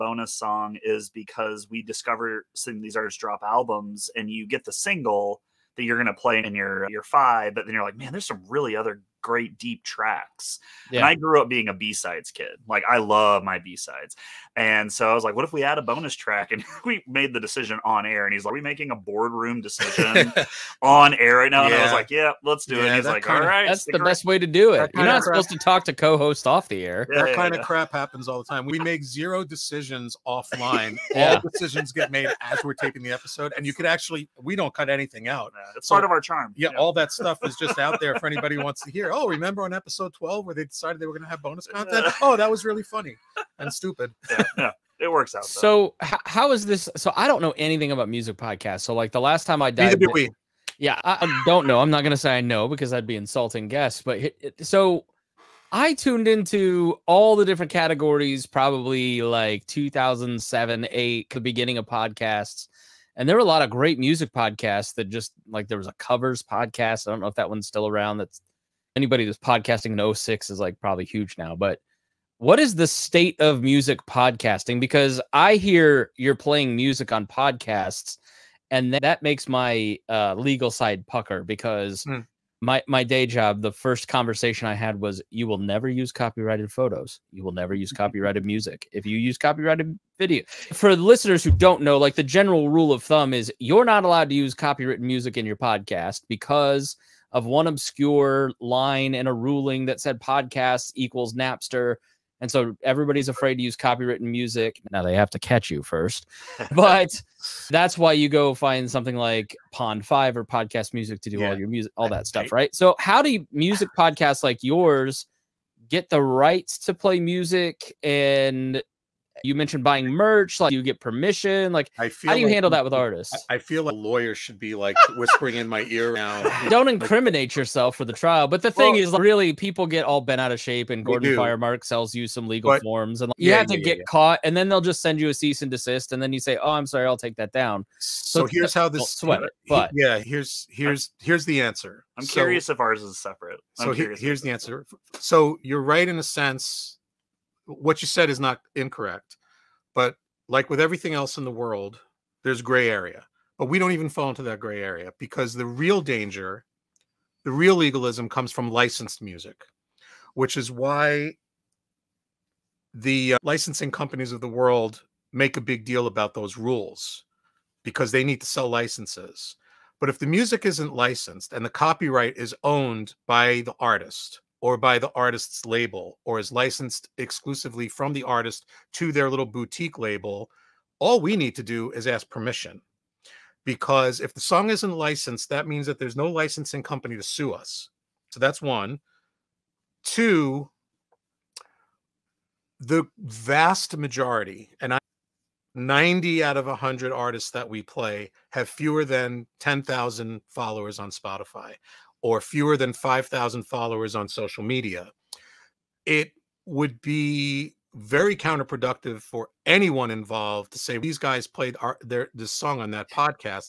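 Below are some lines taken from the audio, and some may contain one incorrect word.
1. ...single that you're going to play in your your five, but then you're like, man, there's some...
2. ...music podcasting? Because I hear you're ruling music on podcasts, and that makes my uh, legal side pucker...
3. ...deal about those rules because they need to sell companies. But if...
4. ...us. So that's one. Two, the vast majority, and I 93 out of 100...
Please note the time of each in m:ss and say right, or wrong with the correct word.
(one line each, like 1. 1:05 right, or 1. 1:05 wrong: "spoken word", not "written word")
1. 0:04 right
2. 1:13 wrong: "playing", not "ruling"
3. 2:45 wrong: "licenses", not "companies"
4. 3:07 wrong: "90", not "93".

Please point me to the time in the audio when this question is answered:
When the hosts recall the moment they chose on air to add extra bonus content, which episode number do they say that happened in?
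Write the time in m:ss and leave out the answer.
0:39.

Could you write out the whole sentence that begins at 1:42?
And so everybody's afraid to use copywritten music.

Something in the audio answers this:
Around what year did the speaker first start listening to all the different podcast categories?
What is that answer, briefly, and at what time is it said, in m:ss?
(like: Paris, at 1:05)
2007, at 0:59.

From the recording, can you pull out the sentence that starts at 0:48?
So, like the last time I died, yeah, I don't know.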